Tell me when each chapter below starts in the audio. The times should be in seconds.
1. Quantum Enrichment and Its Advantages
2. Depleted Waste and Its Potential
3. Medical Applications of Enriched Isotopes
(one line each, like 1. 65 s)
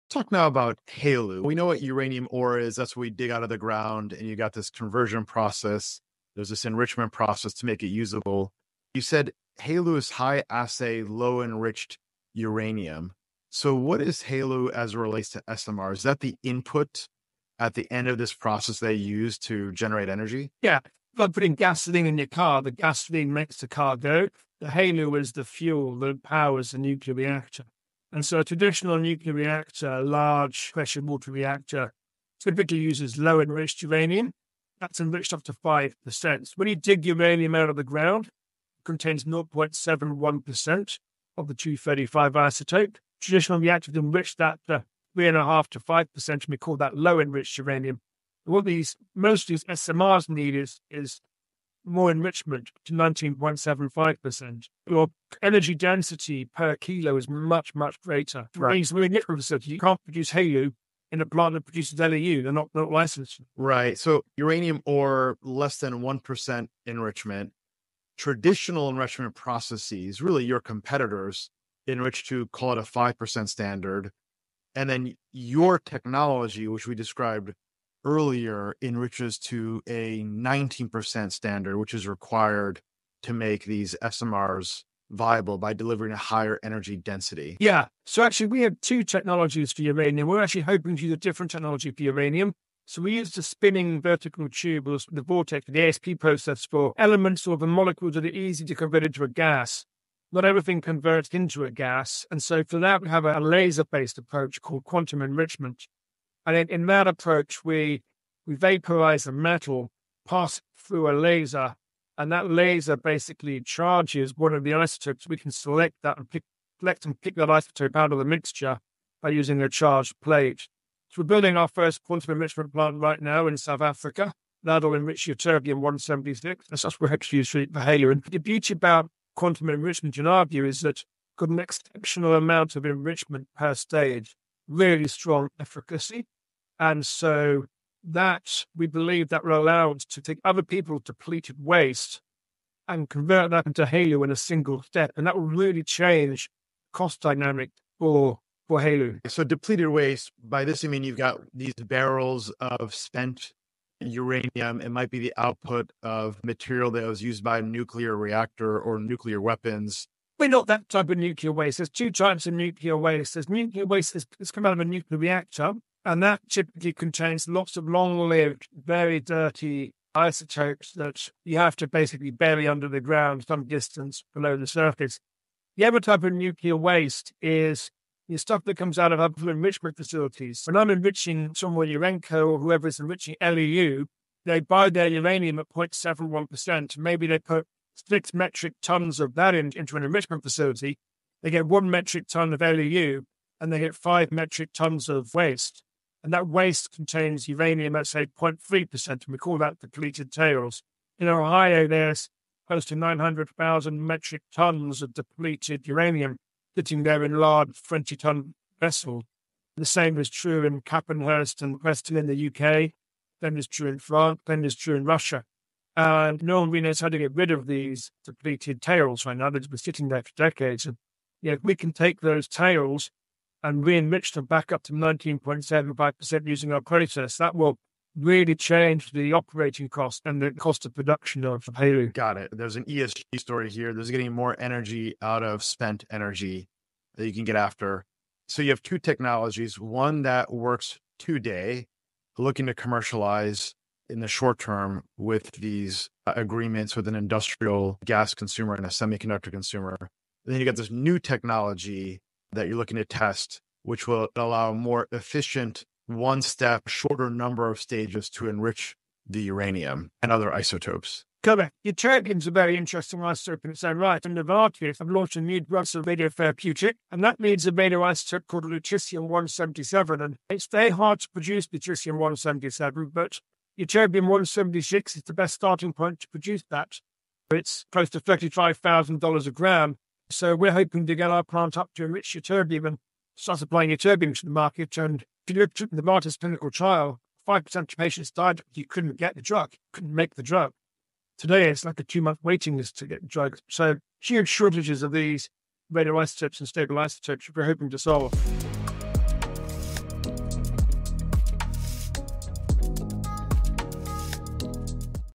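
1. 125 s
2. 153 s
3. 278 s.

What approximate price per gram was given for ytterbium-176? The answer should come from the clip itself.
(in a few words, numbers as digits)
$35,000.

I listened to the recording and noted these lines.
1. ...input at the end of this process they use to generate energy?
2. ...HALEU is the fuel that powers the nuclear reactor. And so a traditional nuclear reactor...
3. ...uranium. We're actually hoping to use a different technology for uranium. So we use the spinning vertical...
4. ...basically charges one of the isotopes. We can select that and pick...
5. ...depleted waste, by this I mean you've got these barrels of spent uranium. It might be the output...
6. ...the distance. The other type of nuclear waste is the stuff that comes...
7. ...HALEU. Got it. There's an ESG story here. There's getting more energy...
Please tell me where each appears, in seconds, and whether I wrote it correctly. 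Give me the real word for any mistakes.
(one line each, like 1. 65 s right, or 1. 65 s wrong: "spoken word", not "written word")
1. 16 s right
2. 24 s right
3. 89 s right
4. 112 s right
5. 149 s right
6. 174 s wrong: "surface", not "distance"
7. 231 s right.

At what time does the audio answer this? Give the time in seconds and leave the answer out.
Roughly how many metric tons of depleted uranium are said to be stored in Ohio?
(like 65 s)
202 s.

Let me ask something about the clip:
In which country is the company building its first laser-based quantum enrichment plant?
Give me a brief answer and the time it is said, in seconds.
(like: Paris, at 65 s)
South Africa, at 123 s.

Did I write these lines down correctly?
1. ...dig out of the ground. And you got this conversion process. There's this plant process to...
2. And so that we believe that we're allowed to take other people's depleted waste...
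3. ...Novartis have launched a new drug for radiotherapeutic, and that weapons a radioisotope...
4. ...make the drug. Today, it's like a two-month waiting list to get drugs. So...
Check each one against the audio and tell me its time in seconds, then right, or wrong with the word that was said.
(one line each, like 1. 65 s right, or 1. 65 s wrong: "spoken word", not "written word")
1. 3 s wrong: "enrichment", not "plant"
2. 136 s right
3. 264 s wrong: "means", not "weapons"
4. 290 s right.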